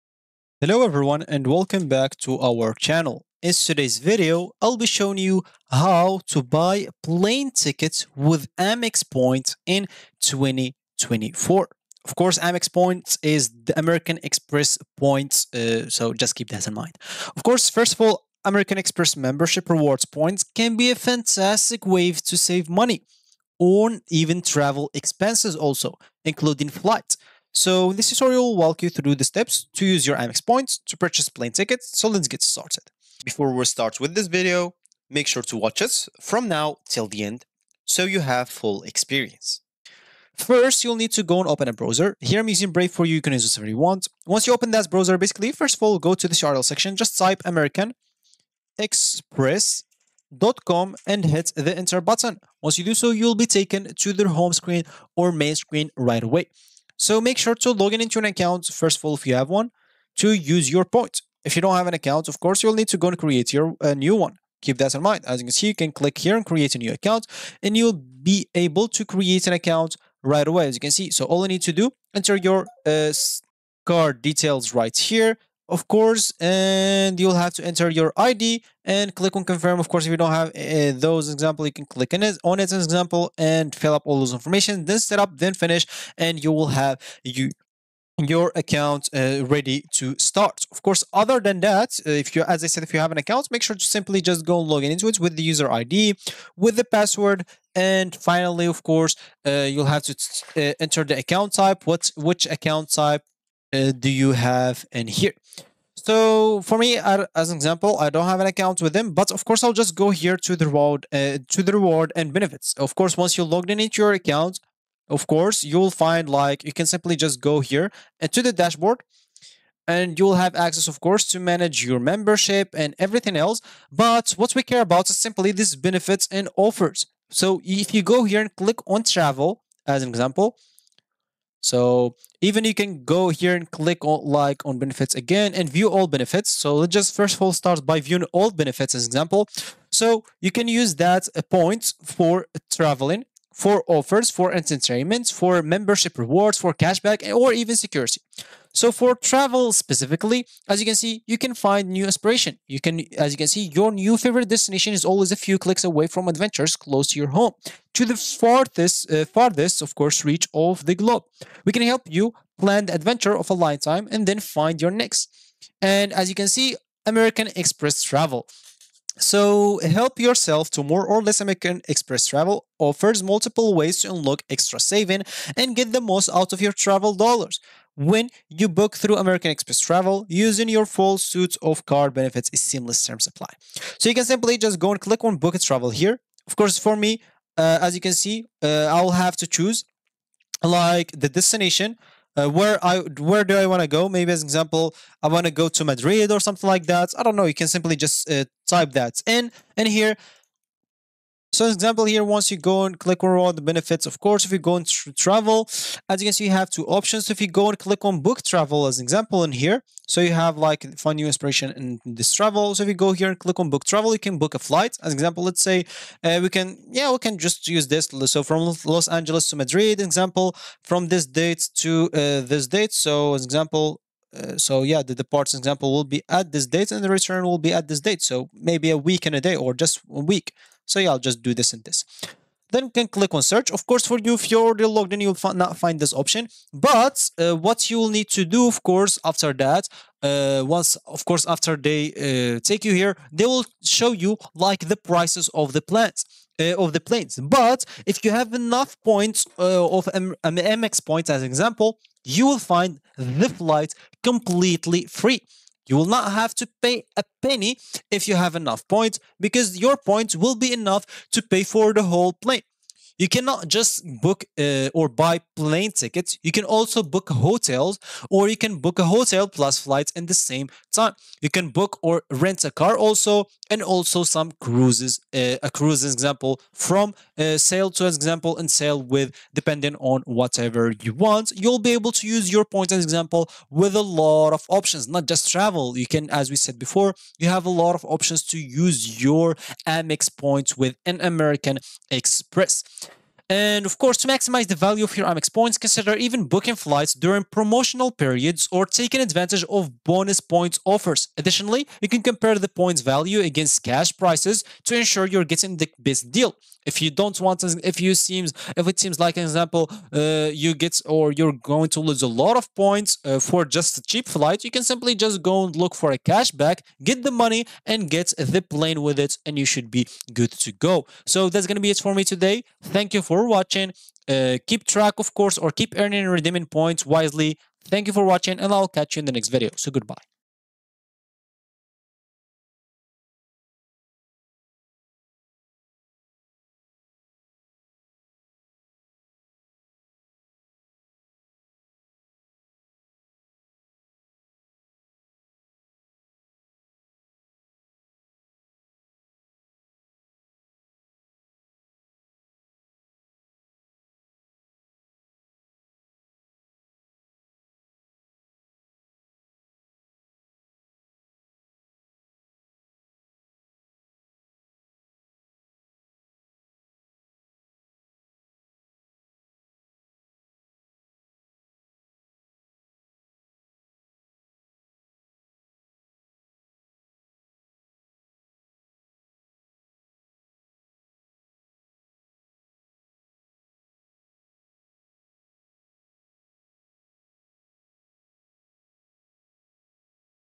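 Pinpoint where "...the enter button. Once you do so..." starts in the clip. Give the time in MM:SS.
00:51.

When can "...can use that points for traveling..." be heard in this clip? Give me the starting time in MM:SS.
02:20.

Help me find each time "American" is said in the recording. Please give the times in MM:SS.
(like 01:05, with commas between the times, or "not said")
00:13, 00:18, 00:47, 02:47, 02:51, 02:59, 04:51.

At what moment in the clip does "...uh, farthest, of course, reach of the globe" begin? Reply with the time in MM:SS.
02:39.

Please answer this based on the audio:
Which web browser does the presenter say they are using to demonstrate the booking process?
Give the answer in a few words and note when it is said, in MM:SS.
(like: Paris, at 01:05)
Brave, at 00:42.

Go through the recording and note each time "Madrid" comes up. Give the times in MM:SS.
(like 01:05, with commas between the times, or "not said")
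03:15, 03:39.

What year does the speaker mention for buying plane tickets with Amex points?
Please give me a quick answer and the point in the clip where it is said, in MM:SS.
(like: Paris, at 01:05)
2024, at 00:10.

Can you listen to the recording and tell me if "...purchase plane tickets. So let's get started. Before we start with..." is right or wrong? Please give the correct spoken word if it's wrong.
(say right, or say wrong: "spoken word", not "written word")
right.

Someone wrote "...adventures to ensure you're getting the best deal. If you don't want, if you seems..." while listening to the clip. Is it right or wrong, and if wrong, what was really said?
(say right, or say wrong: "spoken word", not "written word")
wrong: "prices", not "adventures".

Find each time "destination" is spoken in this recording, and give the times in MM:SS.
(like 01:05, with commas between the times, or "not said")
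02:34, 03:11.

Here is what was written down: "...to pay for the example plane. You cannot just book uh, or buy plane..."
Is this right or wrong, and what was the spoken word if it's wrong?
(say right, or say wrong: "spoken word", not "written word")
wrong: "whole", not "example".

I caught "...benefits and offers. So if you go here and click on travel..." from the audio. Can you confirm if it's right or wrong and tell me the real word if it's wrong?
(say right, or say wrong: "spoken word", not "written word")
right.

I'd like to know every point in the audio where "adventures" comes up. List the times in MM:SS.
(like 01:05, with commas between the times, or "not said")
02:36, 02:42.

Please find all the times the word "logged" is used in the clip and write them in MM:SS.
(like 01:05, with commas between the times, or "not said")
01:53, 03:54.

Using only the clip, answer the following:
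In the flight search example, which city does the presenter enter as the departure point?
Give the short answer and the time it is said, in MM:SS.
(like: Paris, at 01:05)
Los Angeles, at 03:38.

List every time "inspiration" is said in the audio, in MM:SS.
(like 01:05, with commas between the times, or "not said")
02:32, 03:31.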